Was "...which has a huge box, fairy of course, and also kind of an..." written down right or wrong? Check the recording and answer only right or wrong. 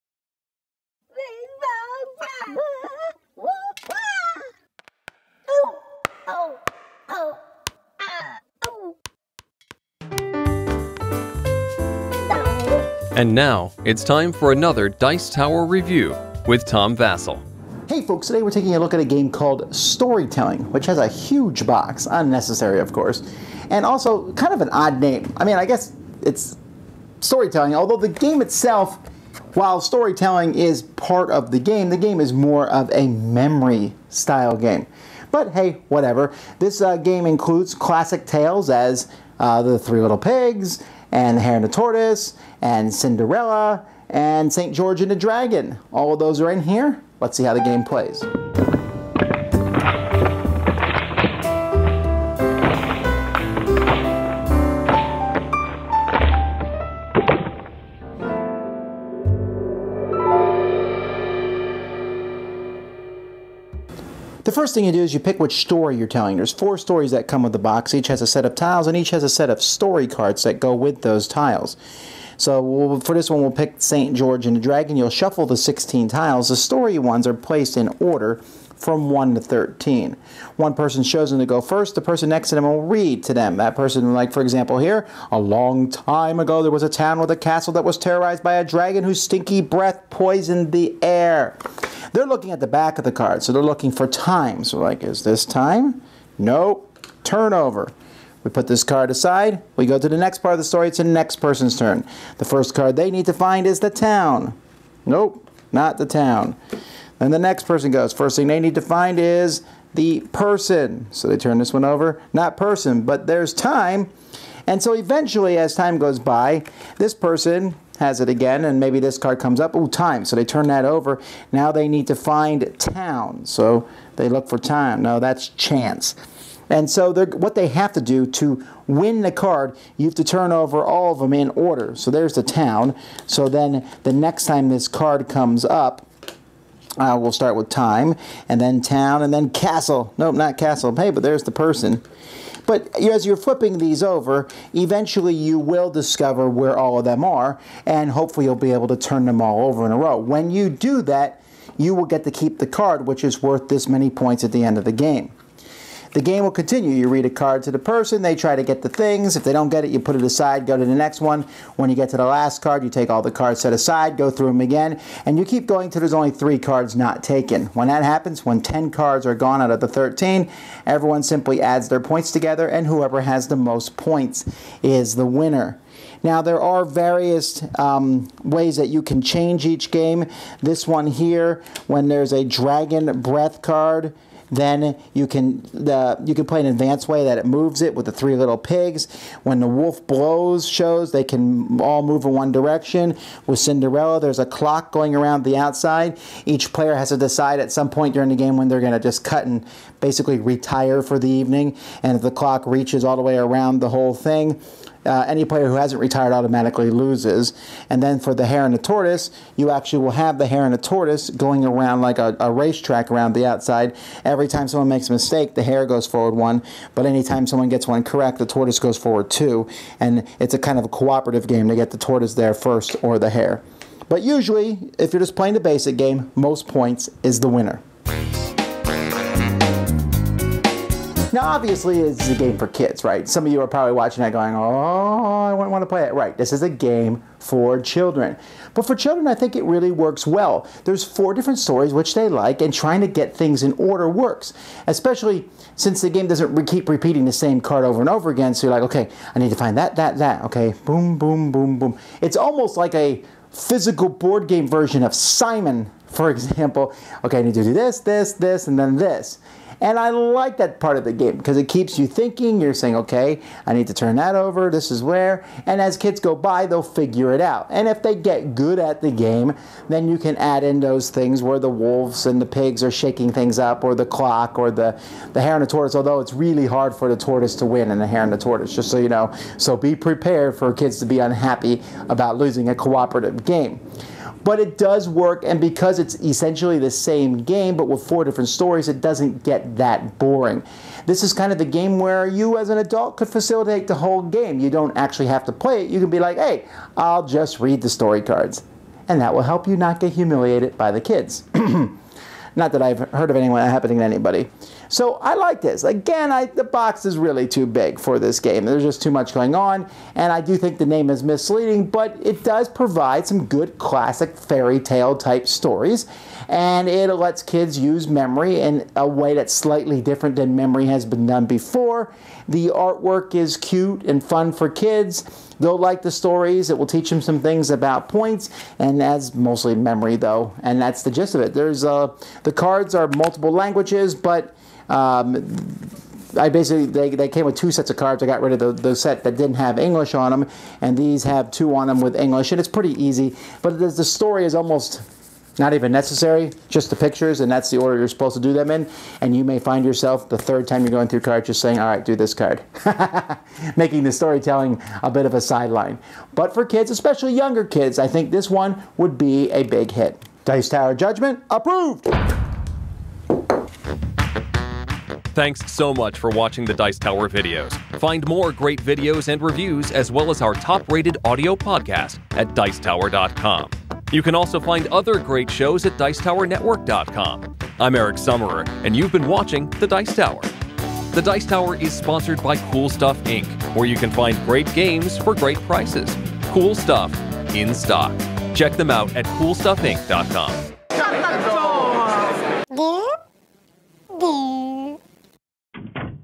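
wrong.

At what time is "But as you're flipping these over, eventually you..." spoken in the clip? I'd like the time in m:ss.
2:22.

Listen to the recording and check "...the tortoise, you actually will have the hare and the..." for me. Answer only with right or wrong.
right.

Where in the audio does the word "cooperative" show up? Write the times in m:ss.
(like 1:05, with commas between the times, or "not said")
3:40, 4:42.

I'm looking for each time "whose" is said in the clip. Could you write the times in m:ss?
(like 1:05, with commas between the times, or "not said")
1:29.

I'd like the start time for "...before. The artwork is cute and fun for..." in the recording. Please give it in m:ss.
5:21.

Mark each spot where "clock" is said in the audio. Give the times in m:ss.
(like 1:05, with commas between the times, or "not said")
3:14, 3:22, 4:34.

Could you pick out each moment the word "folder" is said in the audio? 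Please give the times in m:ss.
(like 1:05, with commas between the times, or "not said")
not said.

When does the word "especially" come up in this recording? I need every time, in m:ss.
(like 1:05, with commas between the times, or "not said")
4:04, 5:56.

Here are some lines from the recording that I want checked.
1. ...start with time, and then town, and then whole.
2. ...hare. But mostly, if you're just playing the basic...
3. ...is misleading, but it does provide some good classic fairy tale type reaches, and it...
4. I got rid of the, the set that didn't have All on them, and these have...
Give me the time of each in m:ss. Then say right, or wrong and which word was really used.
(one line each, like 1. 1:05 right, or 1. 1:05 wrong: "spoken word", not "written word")
1. 2:17 wrong: "castle", not "whole"
2. 3:43 wrong: "usually", not "mostly"
3. 5:11 wrong: "stories", not "reaches"
4. 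5:38 wrong: "English", not "All".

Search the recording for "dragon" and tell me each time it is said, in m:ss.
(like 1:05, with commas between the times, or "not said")
0:45, 1:14, 1:28, 3:02.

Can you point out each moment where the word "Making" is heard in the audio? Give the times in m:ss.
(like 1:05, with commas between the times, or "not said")
5:53.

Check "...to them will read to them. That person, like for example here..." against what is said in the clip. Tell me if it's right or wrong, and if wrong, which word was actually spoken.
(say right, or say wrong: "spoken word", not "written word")
right.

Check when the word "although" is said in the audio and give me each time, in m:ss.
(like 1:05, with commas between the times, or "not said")
0:27, 4:35.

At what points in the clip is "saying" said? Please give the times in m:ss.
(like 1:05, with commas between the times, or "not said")
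4:22, 5:51.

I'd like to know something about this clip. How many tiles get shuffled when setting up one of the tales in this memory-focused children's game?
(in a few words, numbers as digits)
16.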